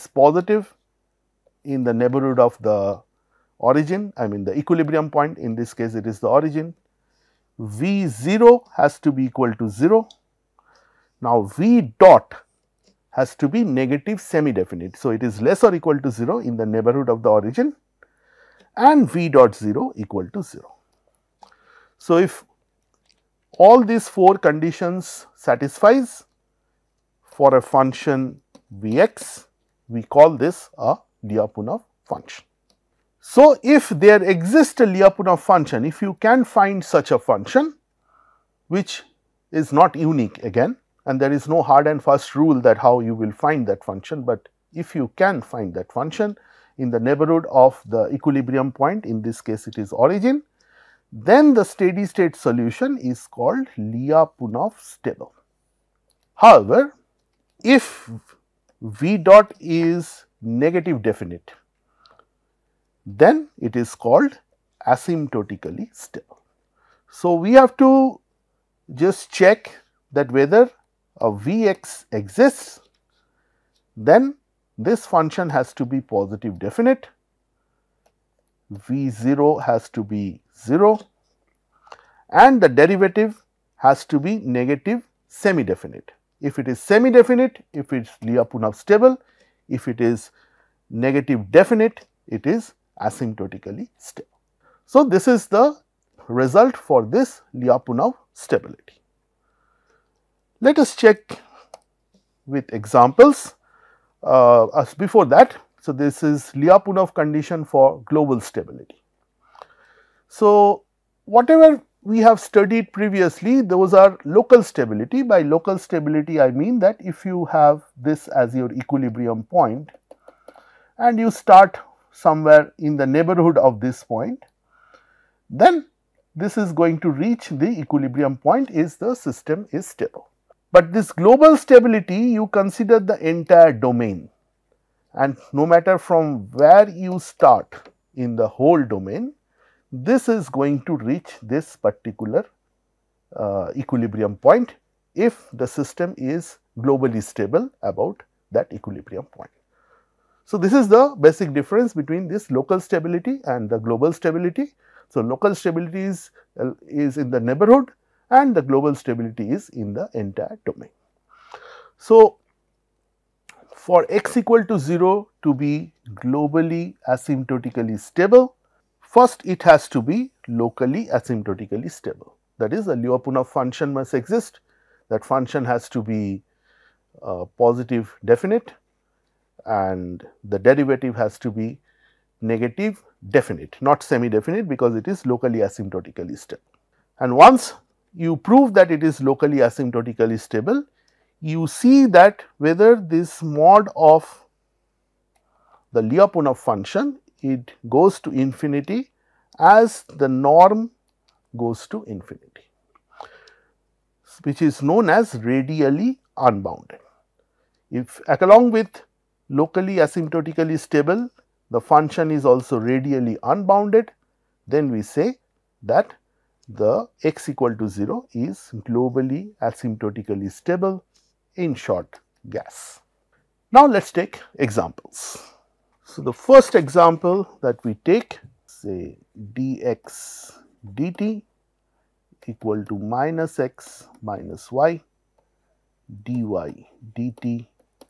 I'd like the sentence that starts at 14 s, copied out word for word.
So, it is less or equal to 0 in the neighborhood of the origin and V dot 0 equal to 0.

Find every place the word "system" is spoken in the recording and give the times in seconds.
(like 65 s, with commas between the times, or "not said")
129 s, 145 s.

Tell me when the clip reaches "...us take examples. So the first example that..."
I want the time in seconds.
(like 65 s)
224 s.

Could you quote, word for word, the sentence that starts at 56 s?
However, if V dot is negative definite, then it is called asymptotically stable.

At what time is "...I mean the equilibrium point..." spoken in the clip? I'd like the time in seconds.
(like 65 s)
4 s.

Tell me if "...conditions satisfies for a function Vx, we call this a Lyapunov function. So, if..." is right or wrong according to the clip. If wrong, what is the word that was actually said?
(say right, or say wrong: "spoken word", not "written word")
right.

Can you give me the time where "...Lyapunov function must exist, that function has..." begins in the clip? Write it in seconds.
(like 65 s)
172 s.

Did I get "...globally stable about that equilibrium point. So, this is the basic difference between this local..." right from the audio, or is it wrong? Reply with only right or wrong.
right.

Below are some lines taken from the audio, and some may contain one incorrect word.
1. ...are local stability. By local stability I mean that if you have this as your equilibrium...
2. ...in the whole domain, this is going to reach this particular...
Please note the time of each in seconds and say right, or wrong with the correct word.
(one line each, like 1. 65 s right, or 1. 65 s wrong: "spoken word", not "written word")
1. 113 s right
2. 138 s right.